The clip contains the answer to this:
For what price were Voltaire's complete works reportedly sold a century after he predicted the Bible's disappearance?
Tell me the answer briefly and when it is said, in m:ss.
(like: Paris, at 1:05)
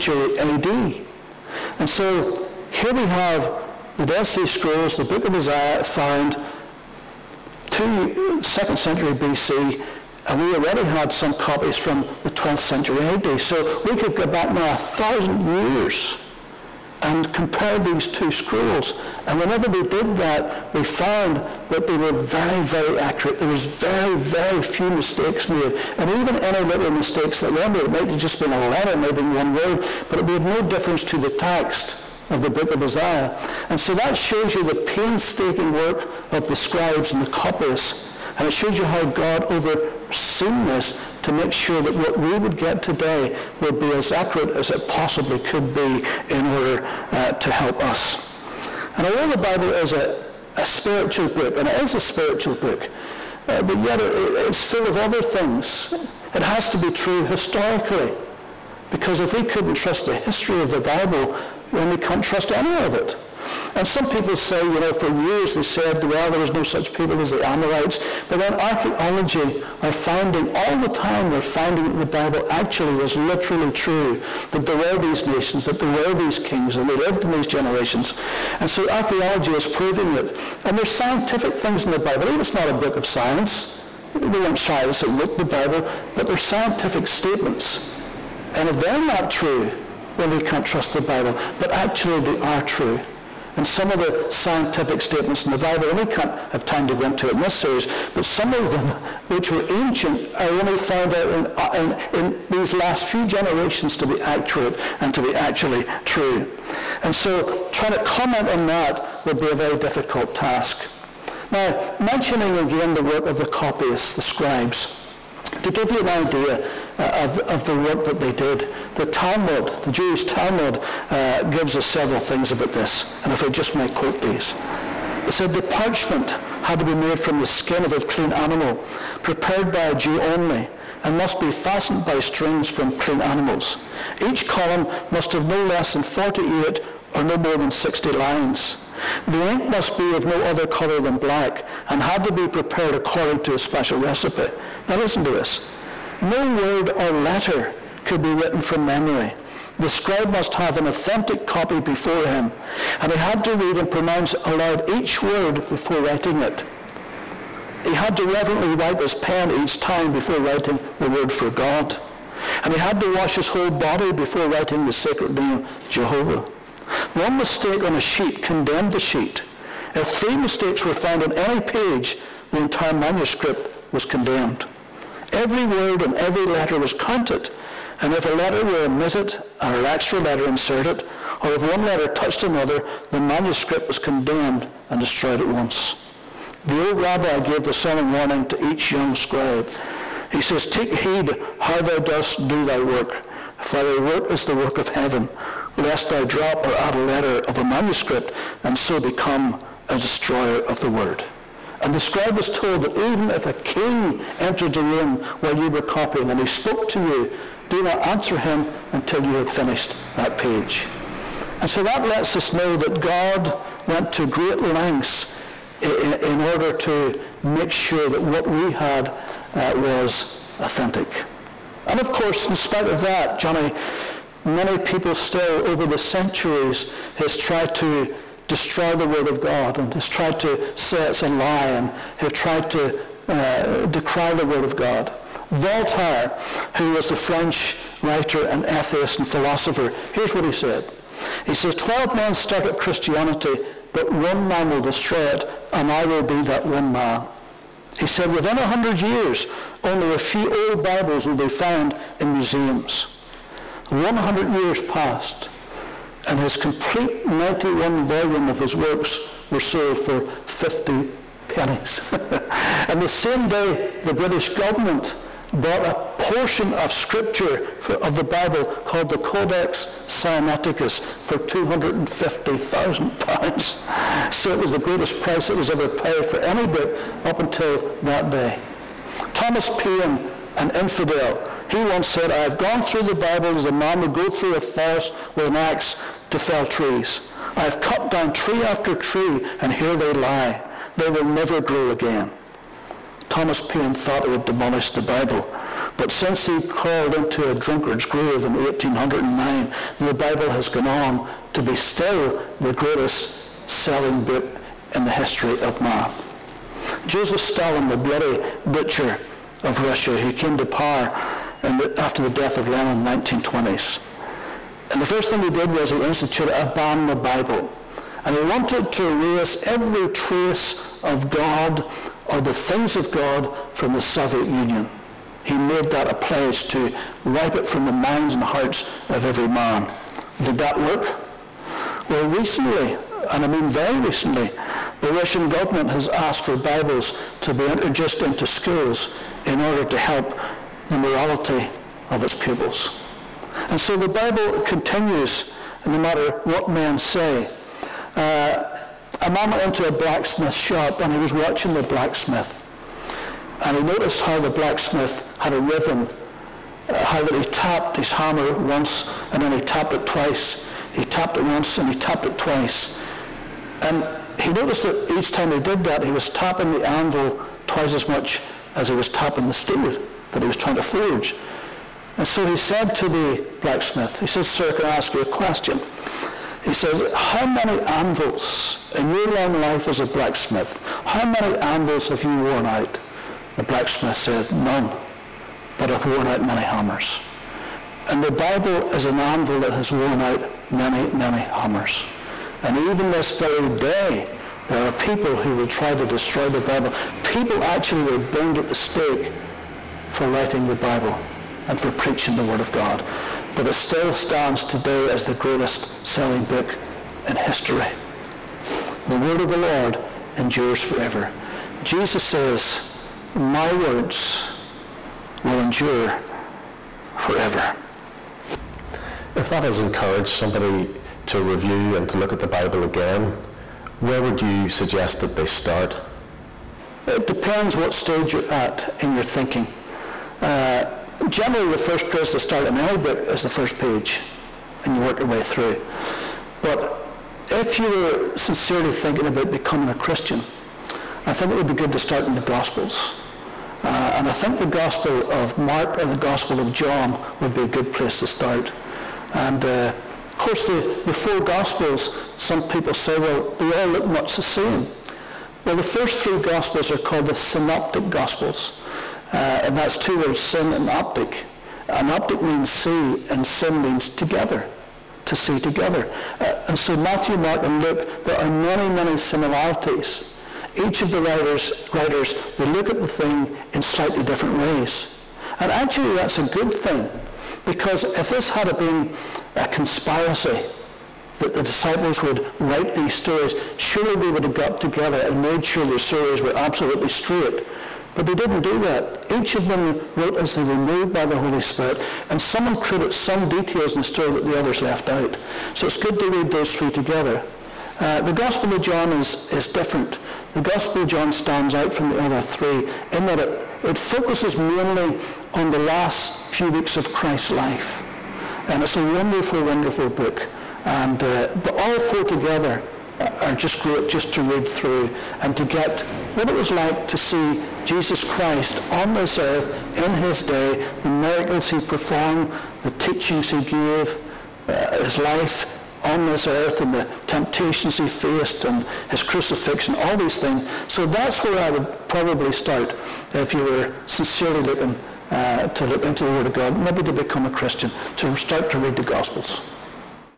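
50 pennies, at 4:20.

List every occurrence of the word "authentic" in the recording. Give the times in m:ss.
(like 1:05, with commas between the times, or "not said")
2:30, 3:40.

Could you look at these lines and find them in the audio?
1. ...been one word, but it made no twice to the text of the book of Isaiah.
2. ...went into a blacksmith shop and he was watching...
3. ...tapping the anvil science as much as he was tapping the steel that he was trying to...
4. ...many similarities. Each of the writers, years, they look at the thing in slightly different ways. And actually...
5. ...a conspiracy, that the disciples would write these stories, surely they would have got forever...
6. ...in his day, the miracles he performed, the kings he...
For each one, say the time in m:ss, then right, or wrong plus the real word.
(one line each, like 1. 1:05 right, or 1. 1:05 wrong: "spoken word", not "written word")
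1. 0:29 wrong: "difference", not "twice"
2. 5:49 right
3. 6:06 wrong: "twice", not "science"
4. 7:48 wrong: "writers", not "years"
5. 7:59 wrong: "together", not "forever"
6. 8:39 wrong: "teachings", not "kings".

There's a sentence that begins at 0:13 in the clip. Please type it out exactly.
So we could go back now a thousand years and compare these two scrolls.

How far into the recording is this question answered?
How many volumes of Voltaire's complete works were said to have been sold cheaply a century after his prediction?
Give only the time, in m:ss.
4:17.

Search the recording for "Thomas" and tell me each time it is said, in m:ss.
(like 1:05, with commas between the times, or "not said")
4:39, 4:53.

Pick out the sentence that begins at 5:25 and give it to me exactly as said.
He made that a pledge to wipe it from the minds and hearts of every man.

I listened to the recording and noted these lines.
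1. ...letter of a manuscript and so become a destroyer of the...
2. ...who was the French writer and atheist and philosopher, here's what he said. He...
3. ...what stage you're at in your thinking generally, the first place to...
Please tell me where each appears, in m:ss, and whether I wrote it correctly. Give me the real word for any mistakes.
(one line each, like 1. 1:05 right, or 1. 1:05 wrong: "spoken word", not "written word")
1. 3:16 right
2. 3:56 right
3. 7:07 right.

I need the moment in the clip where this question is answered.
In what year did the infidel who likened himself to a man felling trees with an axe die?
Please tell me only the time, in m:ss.
4:58.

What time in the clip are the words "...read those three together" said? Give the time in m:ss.
8:16.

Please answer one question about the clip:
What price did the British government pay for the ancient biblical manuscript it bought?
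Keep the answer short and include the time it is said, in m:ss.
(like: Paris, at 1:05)
£250,000, at 4:31.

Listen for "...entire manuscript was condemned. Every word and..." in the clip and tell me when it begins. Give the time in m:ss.
2:52.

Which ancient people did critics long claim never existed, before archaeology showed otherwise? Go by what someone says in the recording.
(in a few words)
Amorites.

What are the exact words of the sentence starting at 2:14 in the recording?
Each column must have no less than 48 or no more than 60 lines.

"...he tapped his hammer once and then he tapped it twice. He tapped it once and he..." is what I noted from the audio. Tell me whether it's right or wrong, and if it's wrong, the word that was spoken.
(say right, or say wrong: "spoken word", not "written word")
right.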